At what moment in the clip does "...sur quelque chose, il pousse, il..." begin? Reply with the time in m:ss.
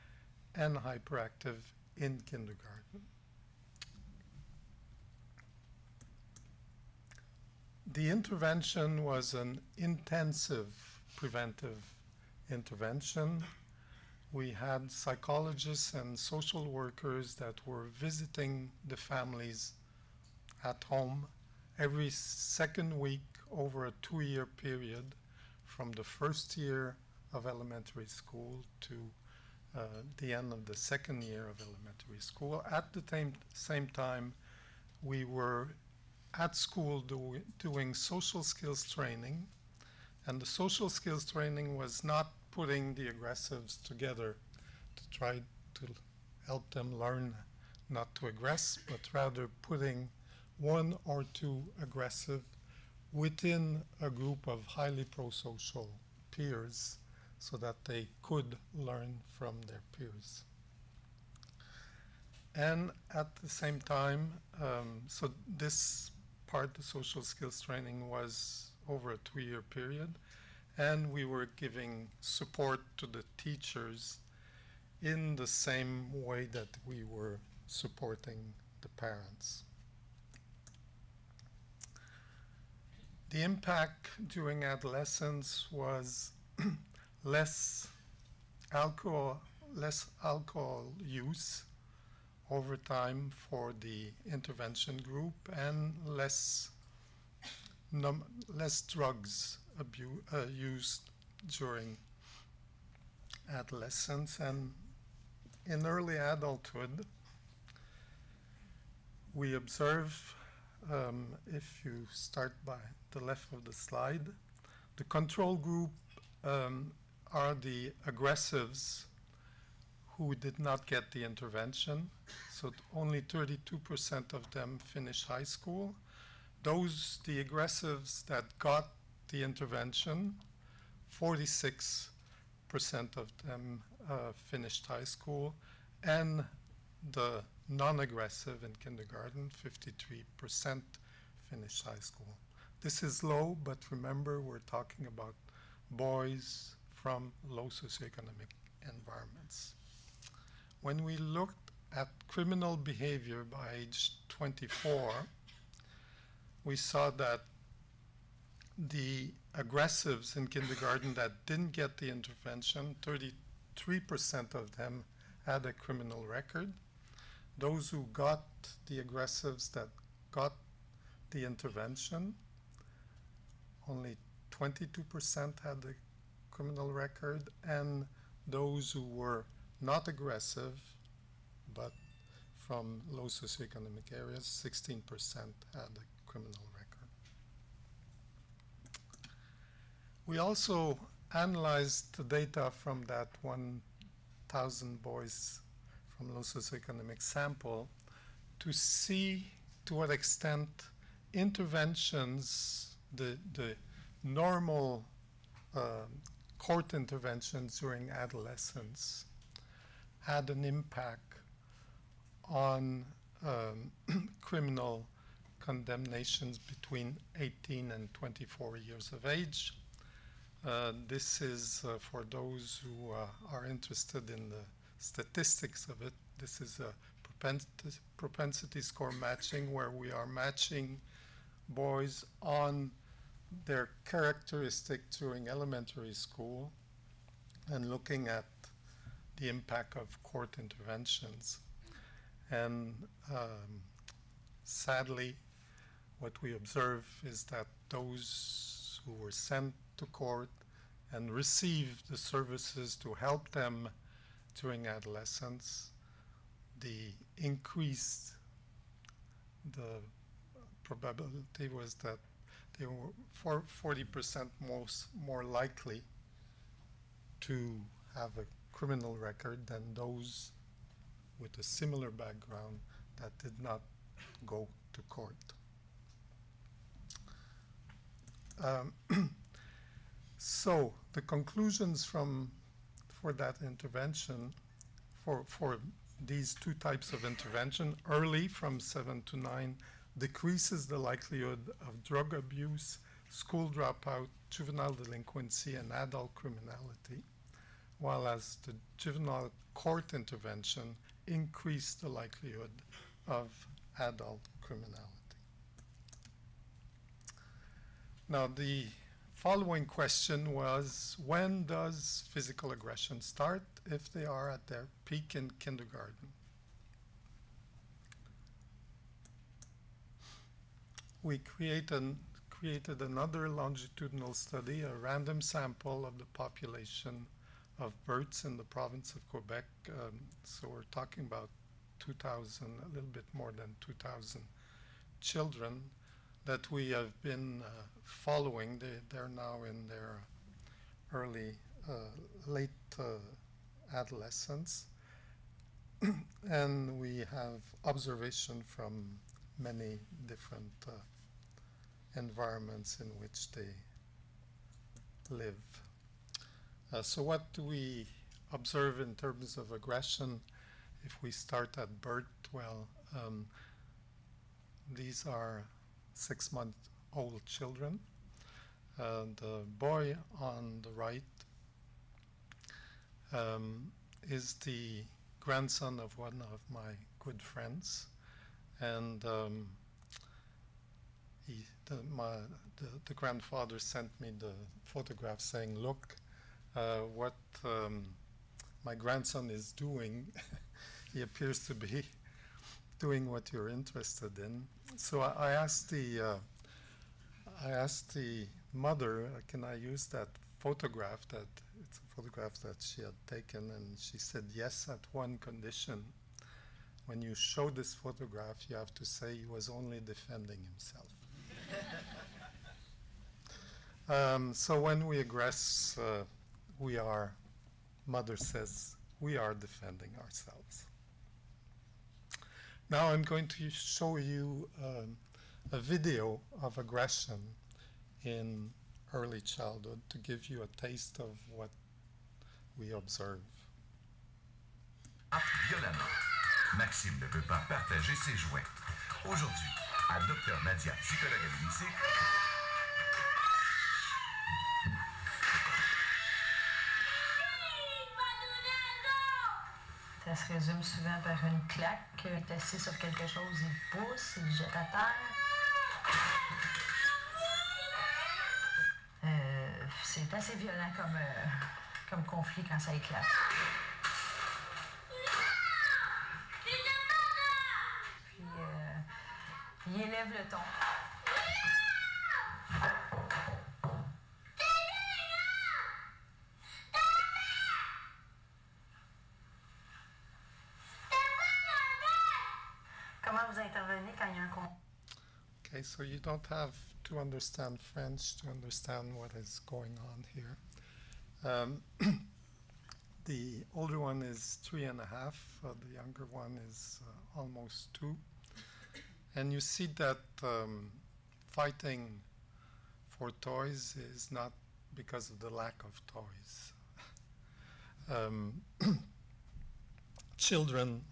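7:32.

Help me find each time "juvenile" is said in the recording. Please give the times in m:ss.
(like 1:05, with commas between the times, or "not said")
4:54, 4:58.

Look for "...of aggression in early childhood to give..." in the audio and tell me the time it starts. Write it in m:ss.
7:06.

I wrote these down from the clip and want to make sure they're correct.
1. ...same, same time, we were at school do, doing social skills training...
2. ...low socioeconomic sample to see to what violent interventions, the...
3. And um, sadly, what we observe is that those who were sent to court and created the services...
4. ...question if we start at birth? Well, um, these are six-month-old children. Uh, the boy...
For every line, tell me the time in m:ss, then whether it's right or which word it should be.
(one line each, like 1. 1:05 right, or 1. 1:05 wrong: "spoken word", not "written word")
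1. 0:33 right
2. 3:16 wrong: "extent", not "violent"
3. 4:02 wrong: "received", not "created"
4. 5:59 wrong: "aggression", not "question".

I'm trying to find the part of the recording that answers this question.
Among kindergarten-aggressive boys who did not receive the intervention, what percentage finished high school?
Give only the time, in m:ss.
2:03.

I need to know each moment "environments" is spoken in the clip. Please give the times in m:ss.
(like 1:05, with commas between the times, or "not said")
2:28, 5:52.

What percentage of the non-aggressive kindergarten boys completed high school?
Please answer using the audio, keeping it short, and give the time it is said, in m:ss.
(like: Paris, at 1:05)
53%, at 2:19.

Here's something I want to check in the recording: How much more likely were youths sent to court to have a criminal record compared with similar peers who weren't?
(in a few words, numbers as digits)
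40%.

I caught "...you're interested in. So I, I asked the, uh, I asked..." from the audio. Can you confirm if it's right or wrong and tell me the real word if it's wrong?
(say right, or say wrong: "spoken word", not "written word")
right.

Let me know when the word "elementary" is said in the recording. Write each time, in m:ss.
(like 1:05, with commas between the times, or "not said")
0:27, 0:31, 3:55.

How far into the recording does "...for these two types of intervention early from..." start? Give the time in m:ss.
4:45.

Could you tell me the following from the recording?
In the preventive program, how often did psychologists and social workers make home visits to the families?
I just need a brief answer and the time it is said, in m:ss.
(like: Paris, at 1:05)
Every second week, at 0:21.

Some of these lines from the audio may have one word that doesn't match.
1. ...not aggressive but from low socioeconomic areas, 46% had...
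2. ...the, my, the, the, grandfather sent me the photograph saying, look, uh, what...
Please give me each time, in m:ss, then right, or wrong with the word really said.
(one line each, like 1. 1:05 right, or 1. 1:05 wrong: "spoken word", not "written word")
1. 2:59 wrong: "16", not "46"
2. 6:21 right.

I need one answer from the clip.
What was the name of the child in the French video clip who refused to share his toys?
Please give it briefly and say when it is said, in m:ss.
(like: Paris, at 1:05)
Maxime, at 7:16.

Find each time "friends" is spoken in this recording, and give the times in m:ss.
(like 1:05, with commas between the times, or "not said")
6:17.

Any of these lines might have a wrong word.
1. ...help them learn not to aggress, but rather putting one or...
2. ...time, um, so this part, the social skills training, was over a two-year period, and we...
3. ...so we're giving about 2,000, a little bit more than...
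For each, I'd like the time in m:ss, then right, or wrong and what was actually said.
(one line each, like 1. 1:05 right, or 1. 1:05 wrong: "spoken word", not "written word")
1. 0:46 right
2. 1:03 right
3. 5:30 wrong: "talking", not "giving".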